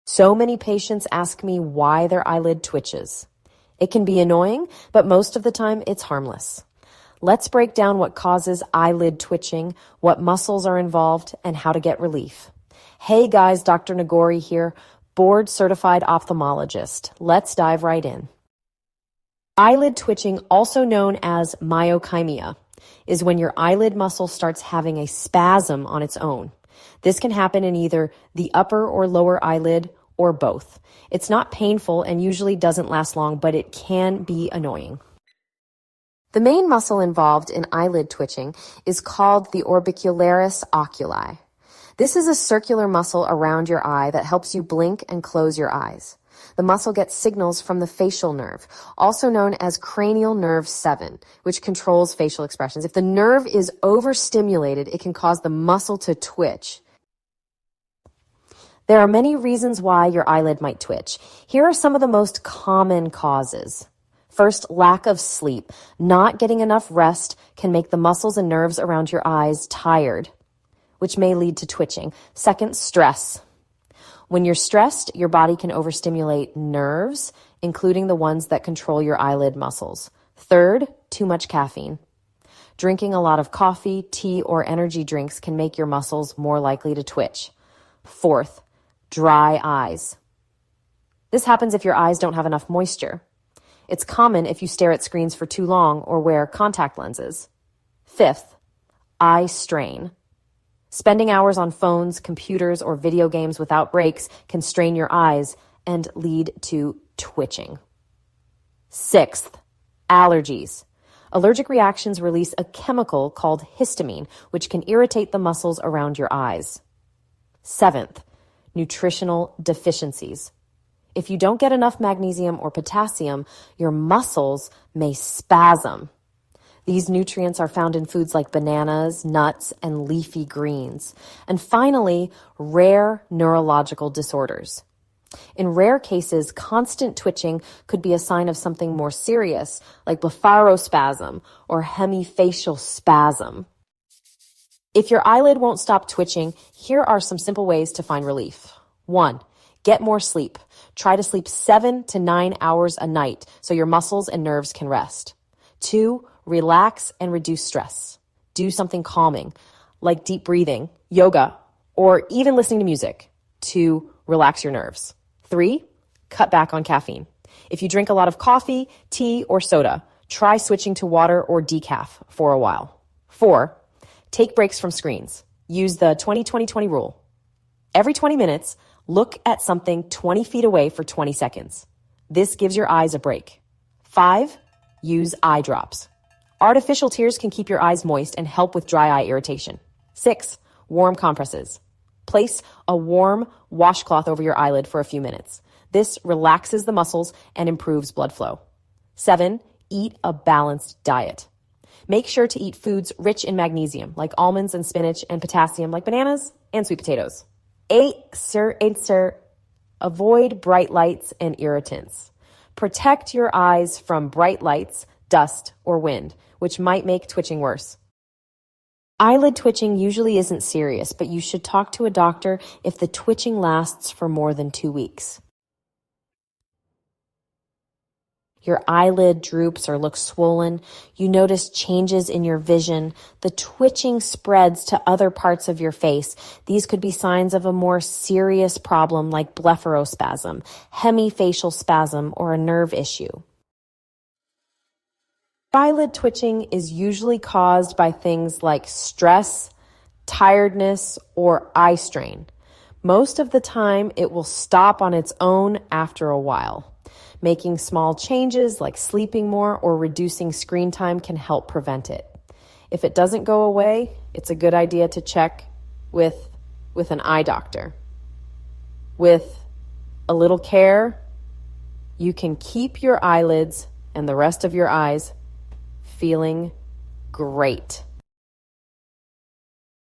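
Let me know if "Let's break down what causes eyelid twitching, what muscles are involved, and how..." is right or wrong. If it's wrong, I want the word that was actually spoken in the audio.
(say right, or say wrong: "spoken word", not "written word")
right.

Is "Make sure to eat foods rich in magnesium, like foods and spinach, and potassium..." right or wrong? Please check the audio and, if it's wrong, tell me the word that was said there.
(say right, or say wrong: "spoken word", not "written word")
wrong: "almonds", not "foods".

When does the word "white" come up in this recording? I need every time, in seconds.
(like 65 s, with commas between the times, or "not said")
not said.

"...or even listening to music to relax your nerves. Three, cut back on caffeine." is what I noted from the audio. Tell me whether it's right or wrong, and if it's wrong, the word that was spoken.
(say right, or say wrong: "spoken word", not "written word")
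right.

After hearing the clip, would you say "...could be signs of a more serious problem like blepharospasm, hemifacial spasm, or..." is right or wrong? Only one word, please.
right.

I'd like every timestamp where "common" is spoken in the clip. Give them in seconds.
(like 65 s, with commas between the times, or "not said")
62 s, 94 s.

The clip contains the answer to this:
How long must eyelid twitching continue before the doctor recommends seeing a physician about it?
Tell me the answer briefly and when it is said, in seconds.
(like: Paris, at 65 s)
more than 2 weeks, at 224 s.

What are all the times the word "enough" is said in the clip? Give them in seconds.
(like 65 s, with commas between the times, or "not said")
66 s, 92 s, 121 s.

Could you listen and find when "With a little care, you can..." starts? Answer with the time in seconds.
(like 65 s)
269 s.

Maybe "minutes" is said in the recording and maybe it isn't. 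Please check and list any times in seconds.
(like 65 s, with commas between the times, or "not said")
178 s, 195 s.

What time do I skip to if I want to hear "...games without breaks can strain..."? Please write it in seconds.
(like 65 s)
103 s.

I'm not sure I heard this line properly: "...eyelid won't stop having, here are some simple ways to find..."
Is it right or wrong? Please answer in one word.
wrong.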